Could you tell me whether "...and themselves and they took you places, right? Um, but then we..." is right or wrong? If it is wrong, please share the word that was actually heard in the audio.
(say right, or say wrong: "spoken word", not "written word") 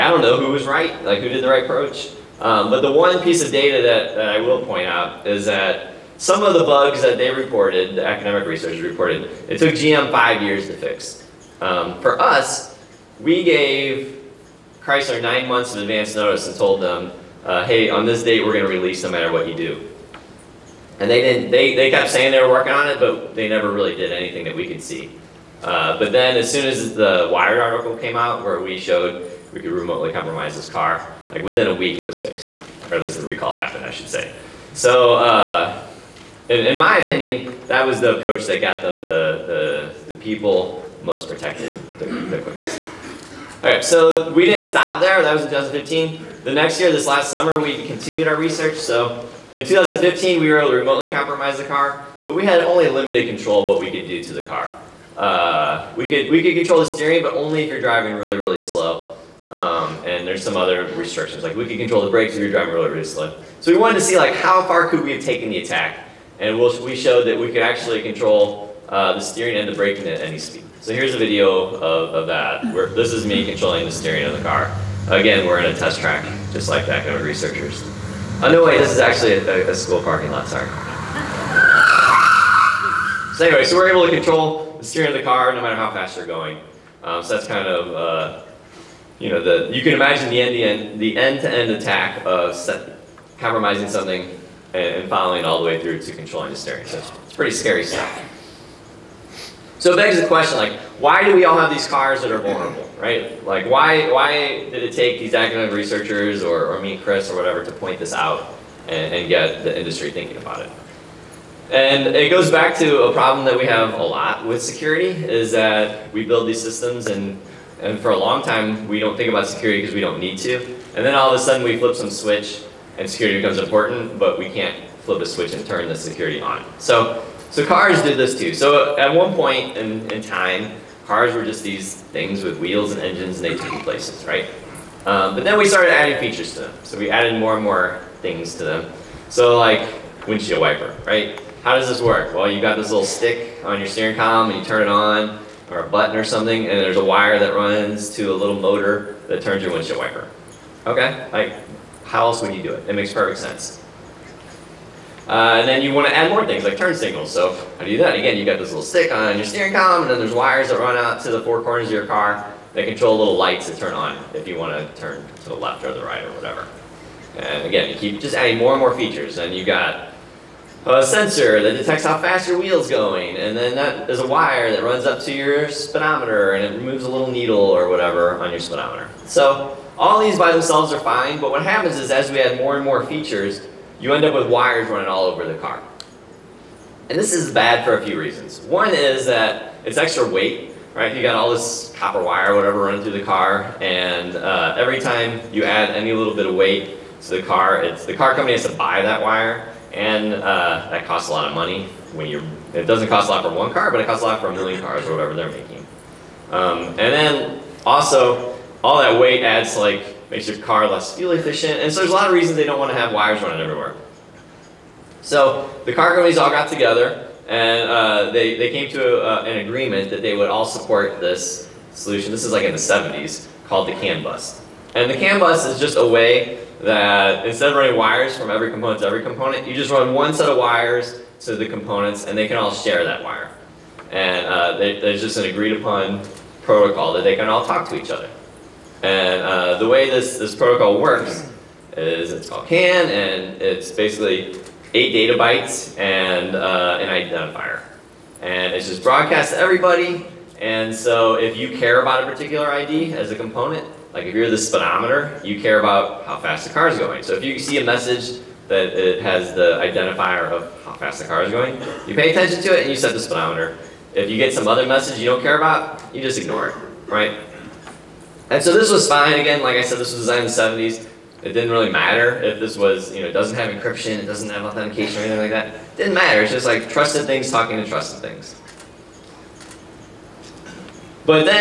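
wrong: "engines", not "themselves".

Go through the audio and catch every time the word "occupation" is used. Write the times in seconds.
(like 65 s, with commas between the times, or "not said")
not said.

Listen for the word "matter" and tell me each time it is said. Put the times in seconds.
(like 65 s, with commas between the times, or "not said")
19 s, 85 s, 271 s, 276 s.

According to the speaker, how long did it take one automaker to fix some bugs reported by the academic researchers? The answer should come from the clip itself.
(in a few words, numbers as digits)
5 years.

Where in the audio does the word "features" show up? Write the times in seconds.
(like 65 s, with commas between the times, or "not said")
136 s, 168 s, 183 s.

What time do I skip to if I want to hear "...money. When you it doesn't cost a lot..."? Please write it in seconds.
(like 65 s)
201 s.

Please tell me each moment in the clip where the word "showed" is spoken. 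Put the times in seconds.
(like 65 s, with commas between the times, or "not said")
28 s, 66 s.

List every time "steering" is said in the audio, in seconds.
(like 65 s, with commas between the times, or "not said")
56 s, 69 s, 73 s, 84 s, 96 s, 143 s, 159 s.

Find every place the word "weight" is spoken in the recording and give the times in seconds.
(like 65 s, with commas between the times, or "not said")
190 s, 196 s, 209 s.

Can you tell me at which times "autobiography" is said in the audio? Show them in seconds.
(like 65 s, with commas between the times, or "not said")
not said.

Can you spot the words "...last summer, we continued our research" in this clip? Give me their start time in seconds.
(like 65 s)
47 s.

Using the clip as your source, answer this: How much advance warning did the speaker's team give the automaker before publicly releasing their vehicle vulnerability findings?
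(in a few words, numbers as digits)
9 months.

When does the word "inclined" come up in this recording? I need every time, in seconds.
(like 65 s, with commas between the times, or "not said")
not said.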